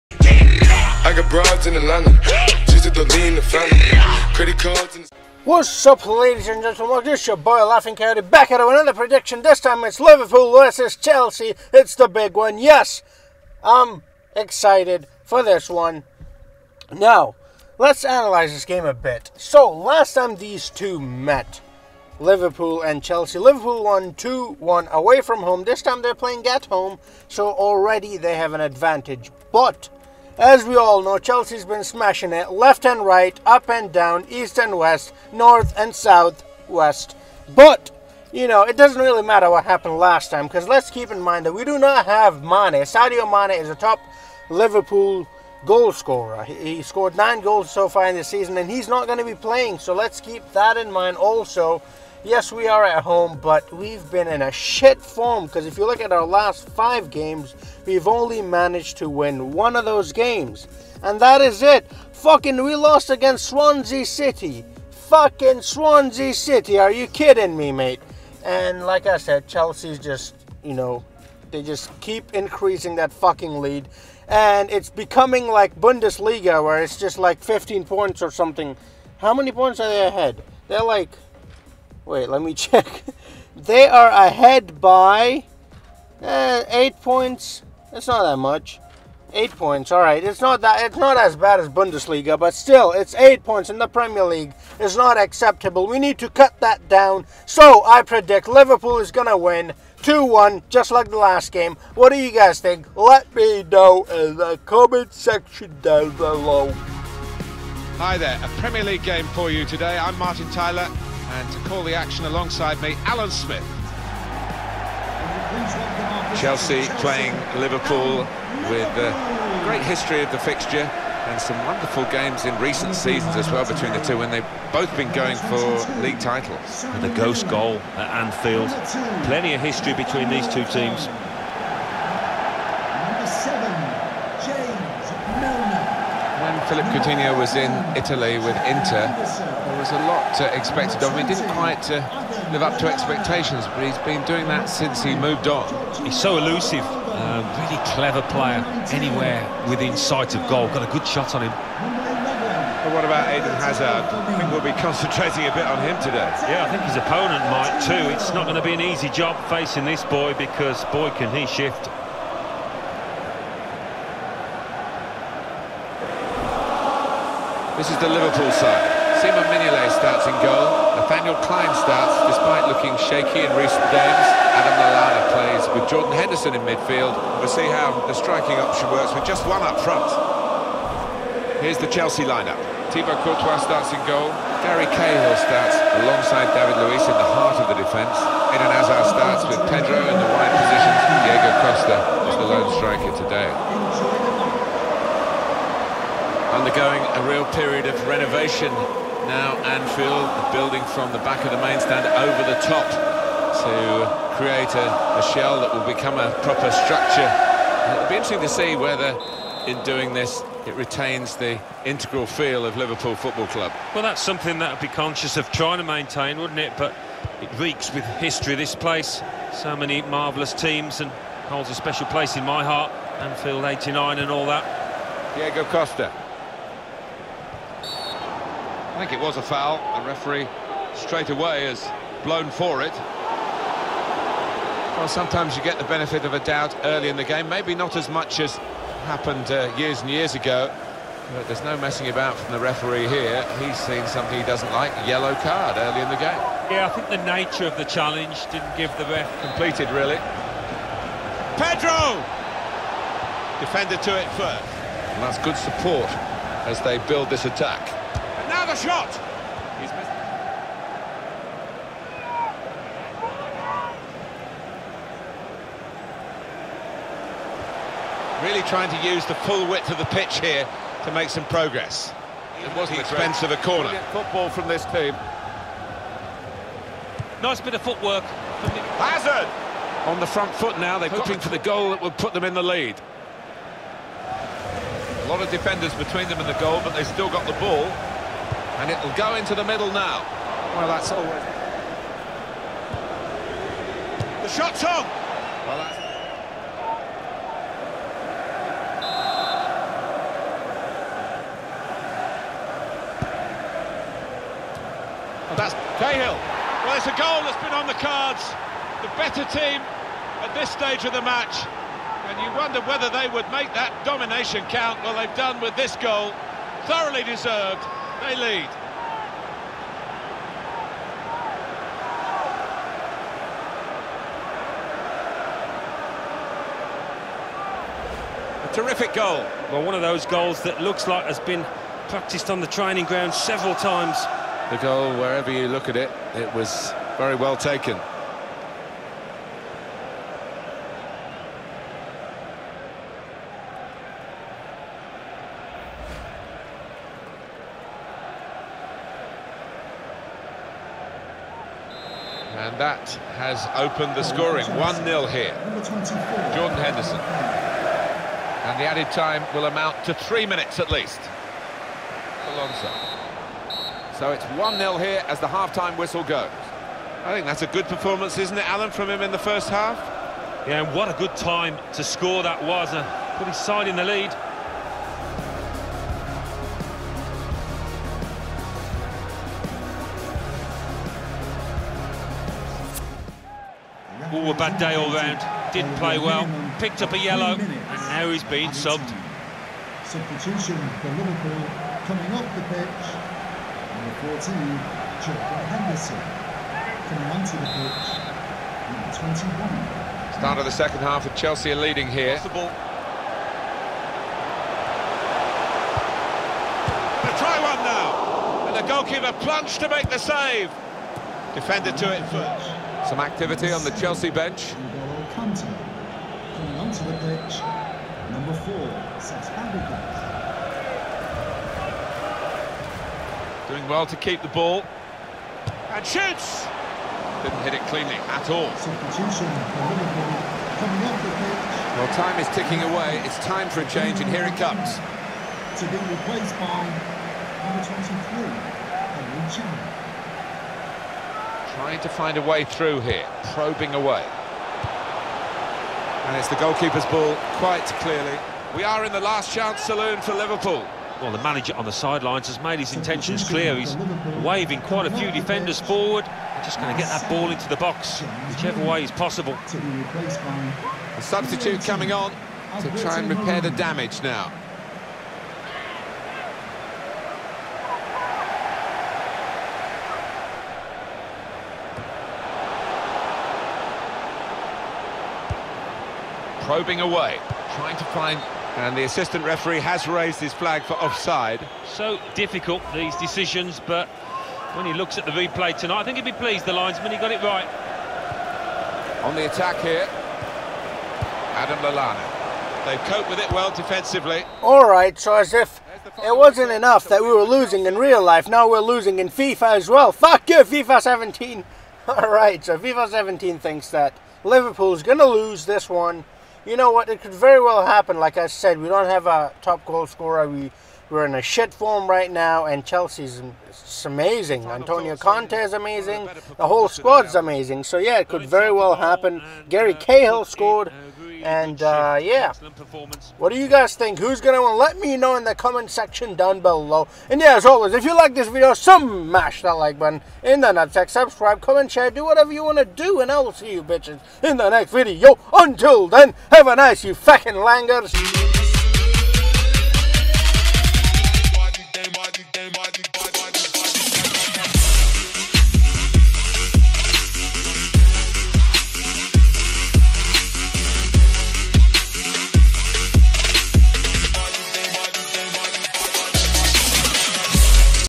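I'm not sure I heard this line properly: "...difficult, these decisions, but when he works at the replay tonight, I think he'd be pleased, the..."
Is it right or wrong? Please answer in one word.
wrong.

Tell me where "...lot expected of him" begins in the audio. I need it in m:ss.
2:20.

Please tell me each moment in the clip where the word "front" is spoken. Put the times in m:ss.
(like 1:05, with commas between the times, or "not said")
2:59, 4:40.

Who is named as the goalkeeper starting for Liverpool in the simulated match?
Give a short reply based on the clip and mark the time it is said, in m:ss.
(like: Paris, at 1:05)
Simon Mignolet, at 2:49.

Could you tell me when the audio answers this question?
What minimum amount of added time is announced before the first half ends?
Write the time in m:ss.
6:00.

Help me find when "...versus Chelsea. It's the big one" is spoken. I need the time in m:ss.
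0:10.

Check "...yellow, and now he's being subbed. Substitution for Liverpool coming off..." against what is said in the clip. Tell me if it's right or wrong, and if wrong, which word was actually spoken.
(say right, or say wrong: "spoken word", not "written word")
right.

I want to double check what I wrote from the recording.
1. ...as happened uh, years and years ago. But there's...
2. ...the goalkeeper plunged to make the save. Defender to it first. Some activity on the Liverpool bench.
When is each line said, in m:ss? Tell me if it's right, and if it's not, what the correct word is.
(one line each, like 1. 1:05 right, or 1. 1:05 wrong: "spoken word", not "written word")
1. 3:58 right
2. 6:48 wrong: "Chelsea", not "Liverpool".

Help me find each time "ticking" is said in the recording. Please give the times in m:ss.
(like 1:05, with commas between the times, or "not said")
7:12.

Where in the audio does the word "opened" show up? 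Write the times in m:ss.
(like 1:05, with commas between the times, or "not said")
5:53.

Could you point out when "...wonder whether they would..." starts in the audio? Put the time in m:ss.
5:12.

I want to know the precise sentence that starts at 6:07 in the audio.
I think that's a good performance, isn't it, Alan, from him in the first half?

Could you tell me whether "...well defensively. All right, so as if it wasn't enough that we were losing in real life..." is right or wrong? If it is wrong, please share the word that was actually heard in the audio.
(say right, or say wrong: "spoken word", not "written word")
right.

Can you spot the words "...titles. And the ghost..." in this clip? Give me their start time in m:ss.
2:06.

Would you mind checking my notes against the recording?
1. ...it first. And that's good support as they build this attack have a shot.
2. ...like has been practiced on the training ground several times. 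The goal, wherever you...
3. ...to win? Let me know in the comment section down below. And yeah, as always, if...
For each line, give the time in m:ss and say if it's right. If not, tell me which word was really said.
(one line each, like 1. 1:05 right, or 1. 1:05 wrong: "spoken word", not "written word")
1. 4:14 right
2. 5:31 right
3. 8:44 right.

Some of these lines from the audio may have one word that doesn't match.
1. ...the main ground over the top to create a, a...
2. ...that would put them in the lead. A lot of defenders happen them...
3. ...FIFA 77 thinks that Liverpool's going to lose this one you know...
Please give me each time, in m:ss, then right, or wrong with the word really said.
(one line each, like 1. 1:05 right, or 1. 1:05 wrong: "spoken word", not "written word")
1. 3:21 wrong: "stand", not "ground"
2. 4:41 wrong: "between", not "happen"
3. 8:22 wrong: "17", not "77".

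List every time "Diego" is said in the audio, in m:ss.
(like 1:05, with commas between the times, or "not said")
3:11, 3:45.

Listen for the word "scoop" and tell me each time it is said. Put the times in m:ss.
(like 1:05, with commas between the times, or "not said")
not said.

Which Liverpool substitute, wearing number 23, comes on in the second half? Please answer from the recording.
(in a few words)
Emre Can.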